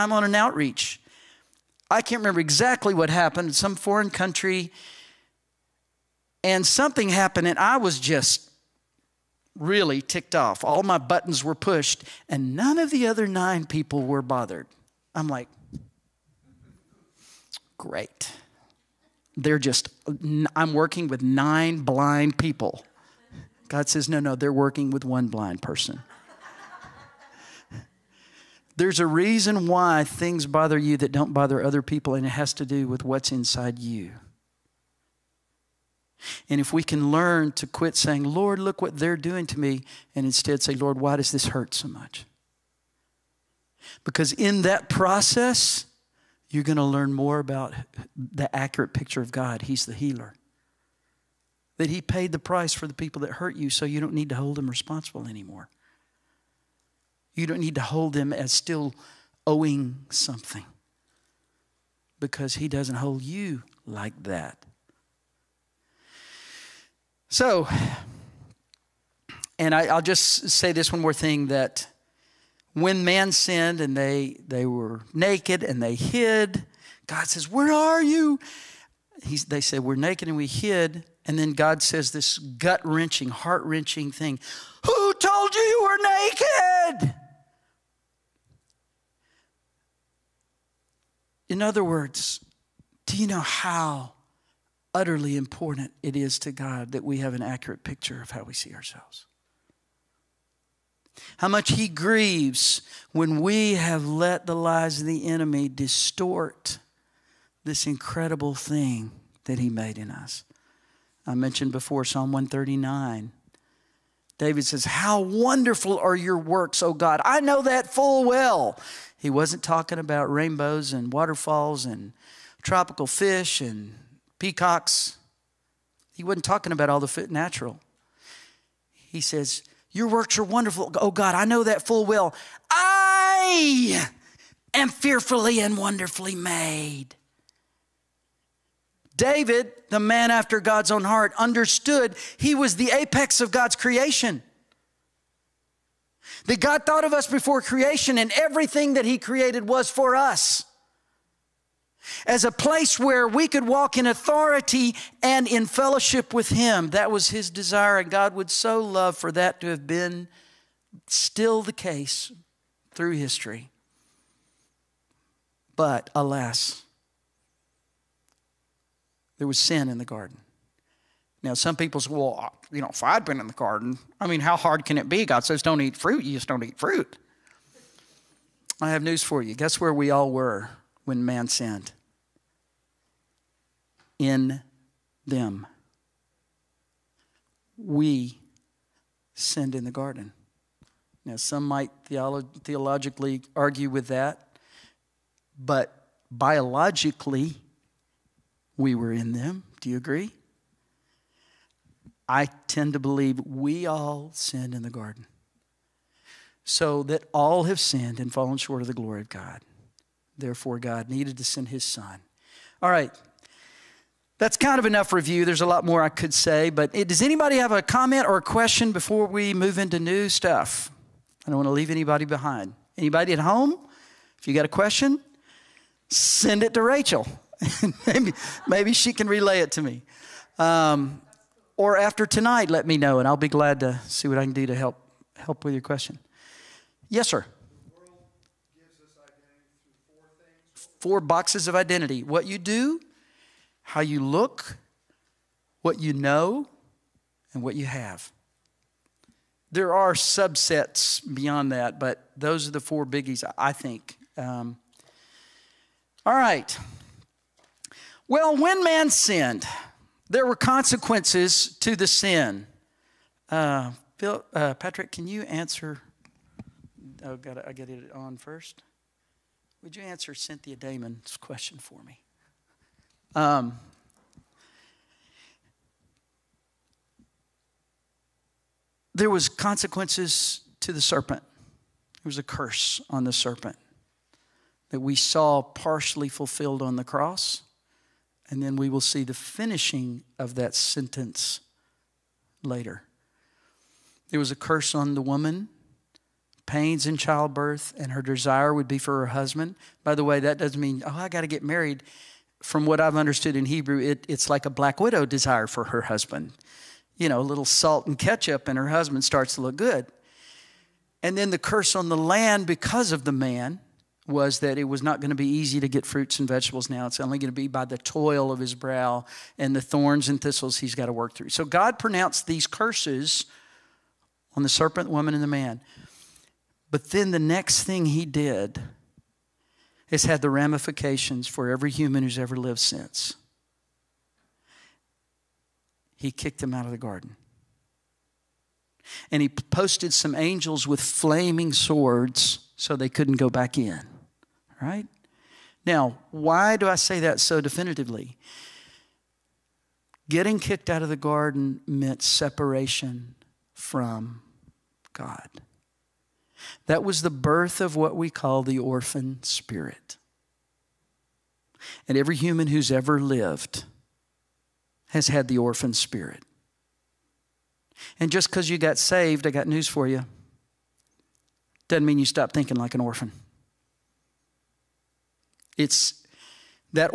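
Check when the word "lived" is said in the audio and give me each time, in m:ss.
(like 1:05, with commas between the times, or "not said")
5:32, 6:03.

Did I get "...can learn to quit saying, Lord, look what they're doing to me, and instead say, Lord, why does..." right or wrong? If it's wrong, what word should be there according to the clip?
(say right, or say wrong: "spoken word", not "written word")
right.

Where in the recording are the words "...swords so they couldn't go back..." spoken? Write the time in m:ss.
5:41.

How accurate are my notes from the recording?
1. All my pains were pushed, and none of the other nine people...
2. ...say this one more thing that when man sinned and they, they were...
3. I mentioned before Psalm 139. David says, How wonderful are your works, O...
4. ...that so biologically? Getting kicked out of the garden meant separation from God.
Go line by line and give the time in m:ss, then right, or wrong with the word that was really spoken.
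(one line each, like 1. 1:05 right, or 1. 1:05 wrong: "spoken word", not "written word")
1. 0:10 wrong: "buttons", not "pains"
2. 1:10 right
3. 1:51 right
4. 5:47 wrong: "definitively", not "biologically".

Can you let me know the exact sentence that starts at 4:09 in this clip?
There are subsets beyond that, but those are the four biggies, I think.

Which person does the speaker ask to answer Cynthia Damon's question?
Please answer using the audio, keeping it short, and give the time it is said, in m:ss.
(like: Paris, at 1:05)
Patrick, at 4:24.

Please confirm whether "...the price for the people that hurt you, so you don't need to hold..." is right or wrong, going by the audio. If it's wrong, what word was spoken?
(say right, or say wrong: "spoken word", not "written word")
right.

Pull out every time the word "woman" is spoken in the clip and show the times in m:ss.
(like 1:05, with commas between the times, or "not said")
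4:55, 5:25.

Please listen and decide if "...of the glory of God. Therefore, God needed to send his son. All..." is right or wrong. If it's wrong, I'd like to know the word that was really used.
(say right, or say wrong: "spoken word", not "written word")
right.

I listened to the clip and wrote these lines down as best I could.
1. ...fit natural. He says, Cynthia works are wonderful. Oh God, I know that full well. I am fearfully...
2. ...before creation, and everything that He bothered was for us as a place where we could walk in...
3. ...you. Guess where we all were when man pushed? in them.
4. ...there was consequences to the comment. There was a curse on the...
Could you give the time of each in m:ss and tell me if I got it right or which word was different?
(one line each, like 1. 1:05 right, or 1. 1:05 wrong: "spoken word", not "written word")
1. 2:07 wrong: "Your", not "Cynthia"
2. 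2:27 wrong: "created", not "bothered"
3. 2:59 wrong: "sinned", not "pushed"
4. 4:39 wrong: "serpent", not "comment".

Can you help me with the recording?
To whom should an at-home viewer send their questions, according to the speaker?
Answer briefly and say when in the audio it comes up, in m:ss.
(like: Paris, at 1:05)
Rachel, at 3:46.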